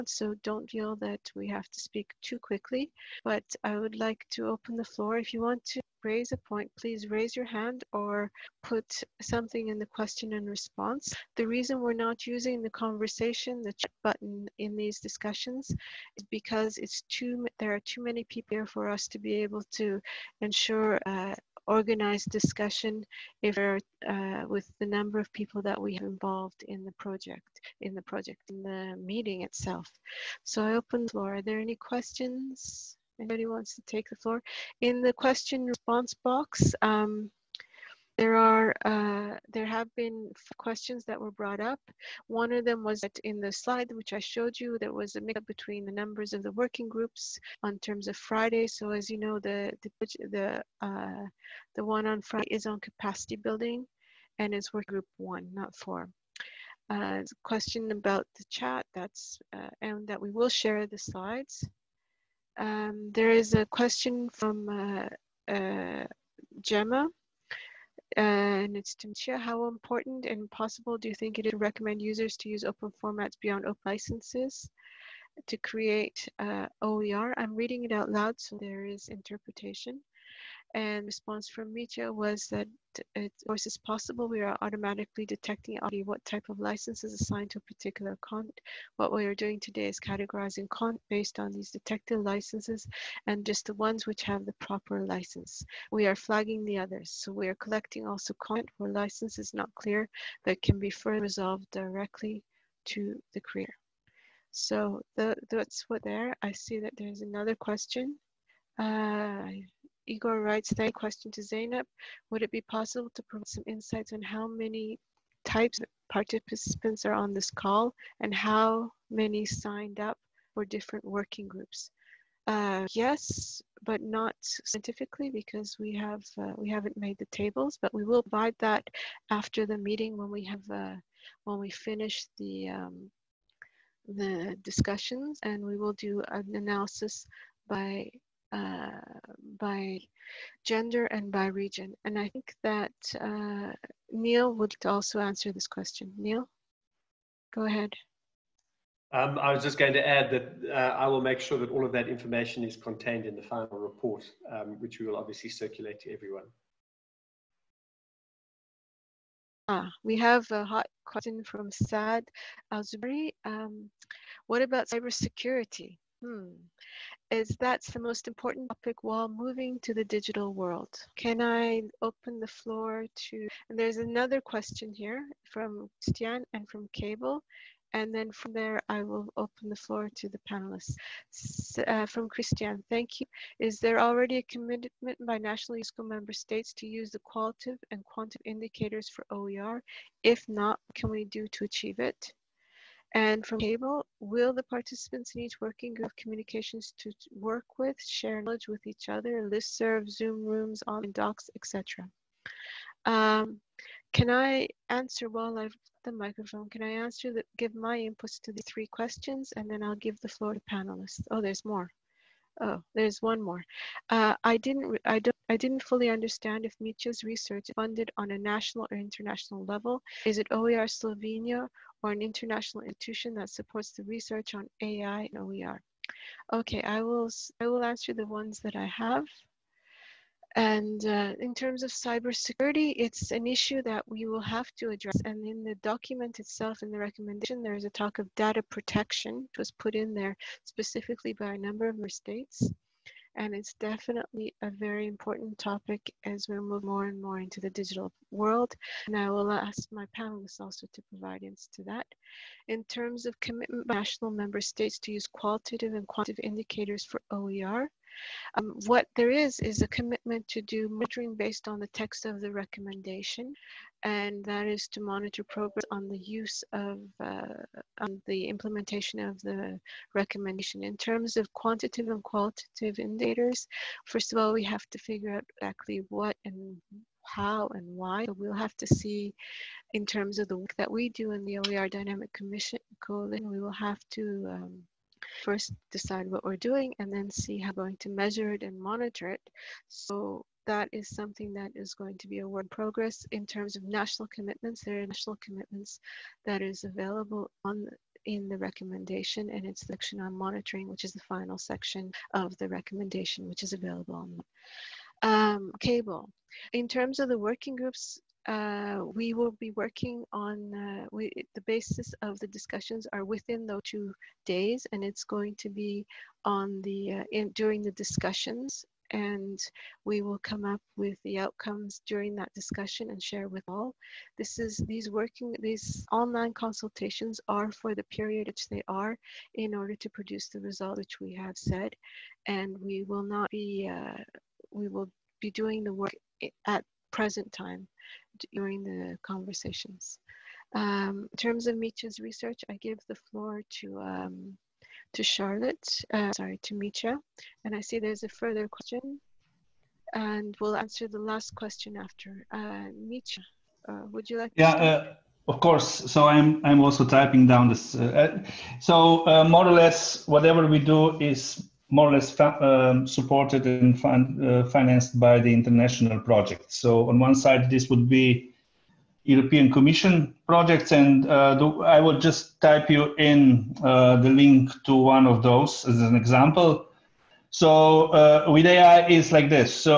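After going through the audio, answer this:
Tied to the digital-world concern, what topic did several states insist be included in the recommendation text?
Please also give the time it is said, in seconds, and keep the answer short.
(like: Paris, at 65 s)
Data protection, at 238 s.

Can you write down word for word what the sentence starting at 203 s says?
Um, can I answer while I've the microphone?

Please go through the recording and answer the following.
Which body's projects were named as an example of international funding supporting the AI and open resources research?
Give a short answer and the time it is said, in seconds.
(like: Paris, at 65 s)
European Commission, at 369 s.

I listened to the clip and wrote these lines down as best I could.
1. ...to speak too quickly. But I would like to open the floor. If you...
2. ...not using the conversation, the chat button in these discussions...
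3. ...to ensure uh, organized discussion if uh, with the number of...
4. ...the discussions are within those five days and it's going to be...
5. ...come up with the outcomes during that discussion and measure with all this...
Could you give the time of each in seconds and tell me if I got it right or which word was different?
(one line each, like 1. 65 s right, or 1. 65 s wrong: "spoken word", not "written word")
1. 1 s right
2. 11 s right
3. 19 s right
4. 312 s wrong: "two", not "five"
5. 320 s wrong: "share", not "measure".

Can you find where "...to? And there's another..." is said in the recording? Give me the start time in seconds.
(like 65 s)
173 s.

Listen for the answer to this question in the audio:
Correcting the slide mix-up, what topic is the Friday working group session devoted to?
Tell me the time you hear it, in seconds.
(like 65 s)
52 s.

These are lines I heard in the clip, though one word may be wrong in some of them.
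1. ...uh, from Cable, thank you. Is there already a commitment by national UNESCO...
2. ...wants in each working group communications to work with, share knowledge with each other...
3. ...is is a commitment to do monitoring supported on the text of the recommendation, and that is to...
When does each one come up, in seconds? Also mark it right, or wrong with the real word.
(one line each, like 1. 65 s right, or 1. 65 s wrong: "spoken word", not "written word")
1. 181 s wrong: "Christian", not "Cable"
2. 194 s wrong: "participants", not "wants"
3. 259 s wrong: "based", not "supported".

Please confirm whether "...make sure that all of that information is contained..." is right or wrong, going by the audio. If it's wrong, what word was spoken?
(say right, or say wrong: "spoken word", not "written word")
right.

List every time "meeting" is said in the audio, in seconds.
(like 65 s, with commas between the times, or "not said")
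28 s, 129 s.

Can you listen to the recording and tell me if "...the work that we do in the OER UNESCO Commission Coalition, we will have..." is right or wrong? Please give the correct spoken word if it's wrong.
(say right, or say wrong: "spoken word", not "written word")
wrong: "Dynamic", not "UNESCO".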